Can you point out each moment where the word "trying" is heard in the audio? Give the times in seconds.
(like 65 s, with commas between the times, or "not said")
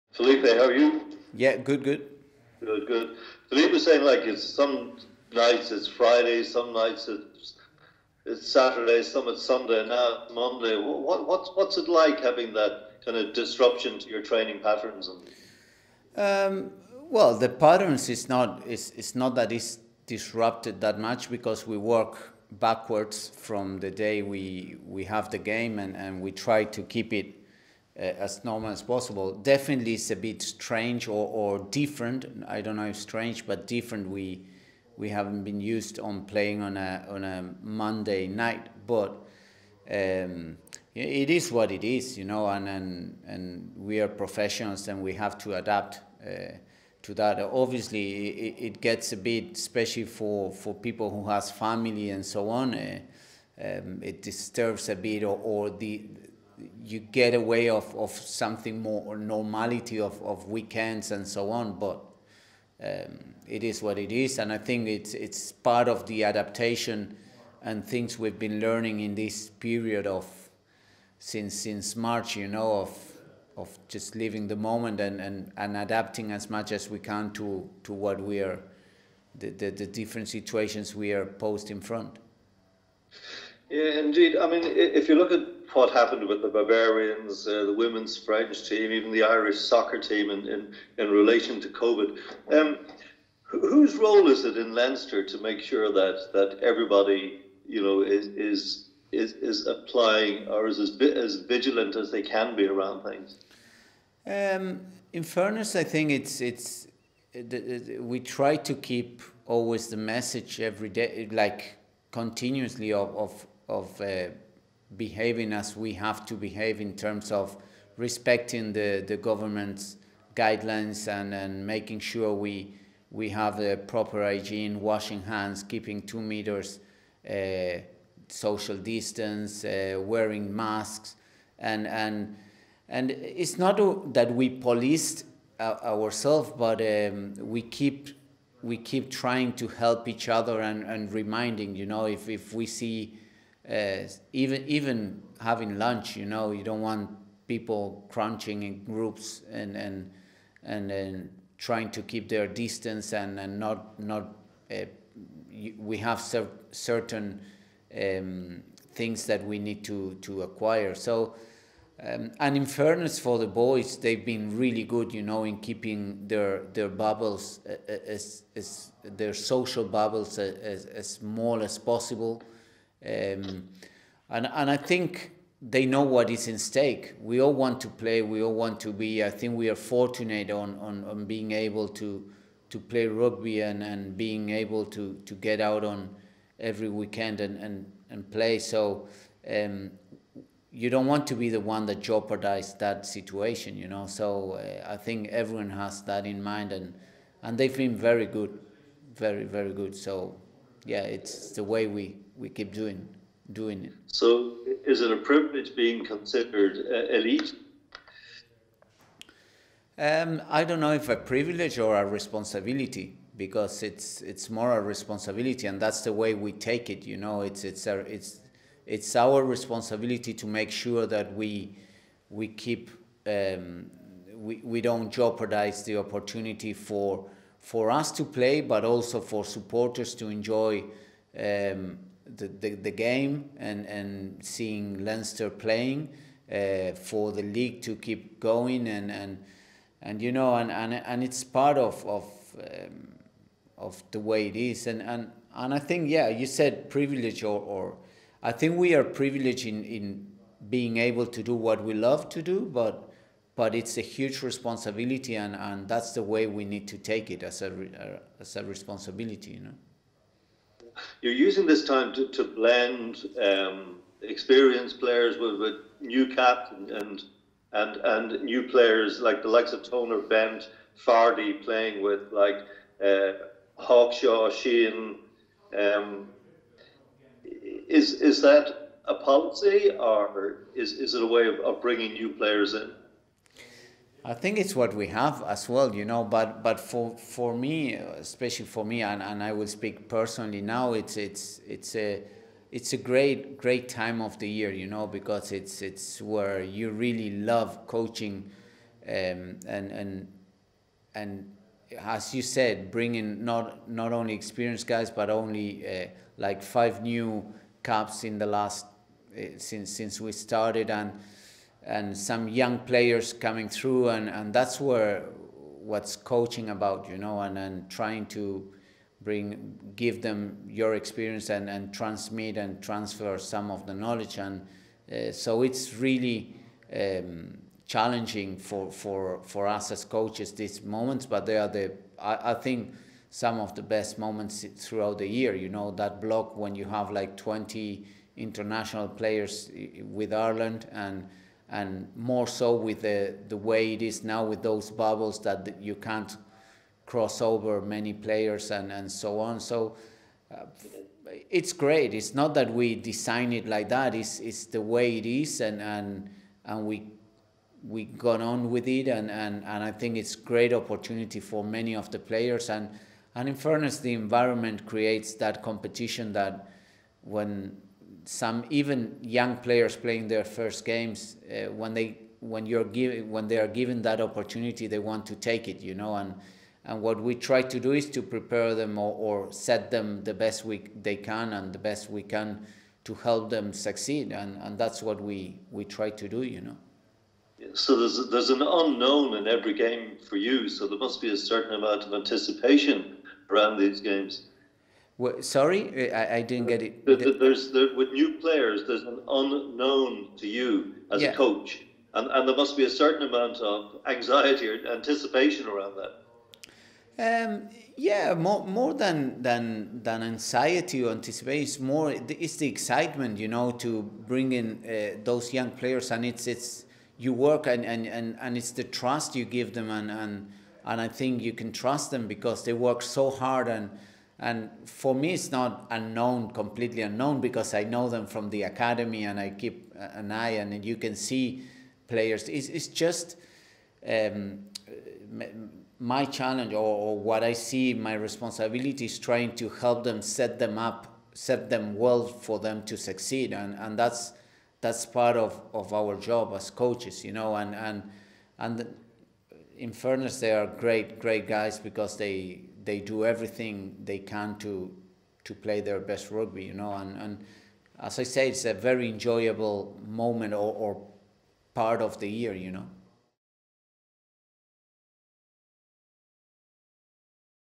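139 s, 151 s, 317 s, 439 s.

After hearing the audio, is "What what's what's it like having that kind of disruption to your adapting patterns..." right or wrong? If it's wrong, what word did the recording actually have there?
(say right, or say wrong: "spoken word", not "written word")
wrong: "training", not "adapting".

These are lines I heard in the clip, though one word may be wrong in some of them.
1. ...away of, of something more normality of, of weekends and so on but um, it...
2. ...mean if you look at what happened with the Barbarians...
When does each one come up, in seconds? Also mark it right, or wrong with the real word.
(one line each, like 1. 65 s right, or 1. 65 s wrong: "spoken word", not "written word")
1. 57 s right
2. 84 s right.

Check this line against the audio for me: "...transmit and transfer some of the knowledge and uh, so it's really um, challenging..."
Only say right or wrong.
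right.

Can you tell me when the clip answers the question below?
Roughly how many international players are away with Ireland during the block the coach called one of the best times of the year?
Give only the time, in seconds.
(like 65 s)
337 s.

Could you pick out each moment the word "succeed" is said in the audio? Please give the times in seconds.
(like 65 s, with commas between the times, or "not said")
383 s, 442 s.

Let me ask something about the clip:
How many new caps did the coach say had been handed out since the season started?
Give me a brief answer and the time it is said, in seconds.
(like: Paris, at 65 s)
5, at 306 s.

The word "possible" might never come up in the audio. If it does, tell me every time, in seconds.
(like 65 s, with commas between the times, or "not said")
28 s, 171 s.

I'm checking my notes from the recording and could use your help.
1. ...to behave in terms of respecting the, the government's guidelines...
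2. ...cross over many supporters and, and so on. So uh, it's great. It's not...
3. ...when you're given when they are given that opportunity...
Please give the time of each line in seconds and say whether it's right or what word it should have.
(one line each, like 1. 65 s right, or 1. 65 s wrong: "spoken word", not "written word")
1. 116 s right
2. 347 s wrong: "players", not "supporters"
3. 372 s right.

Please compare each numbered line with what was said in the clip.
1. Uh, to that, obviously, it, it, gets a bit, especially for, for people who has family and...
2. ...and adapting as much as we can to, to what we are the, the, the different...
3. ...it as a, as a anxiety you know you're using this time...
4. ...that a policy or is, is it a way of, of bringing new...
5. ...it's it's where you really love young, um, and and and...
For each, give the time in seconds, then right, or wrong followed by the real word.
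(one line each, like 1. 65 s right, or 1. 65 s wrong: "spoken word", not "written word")
1. 46 s right
2. 75 s right
3. 257 s wrong: "responsibility", not "anxiety"
4. 278 s right
5. 295 s wrong: "coaching", not "young".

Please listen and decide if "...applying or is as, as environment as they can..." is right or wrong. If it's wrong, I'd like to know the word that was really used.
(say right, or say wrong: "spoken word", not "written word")
wrong: "vigilant", not "environment".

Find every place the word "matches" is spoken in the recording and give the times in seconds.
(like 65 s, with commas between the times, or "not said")
not said.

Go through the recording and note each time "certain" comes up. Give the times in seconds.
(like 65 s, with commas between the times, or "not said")
156 s, 391 s, 402 s.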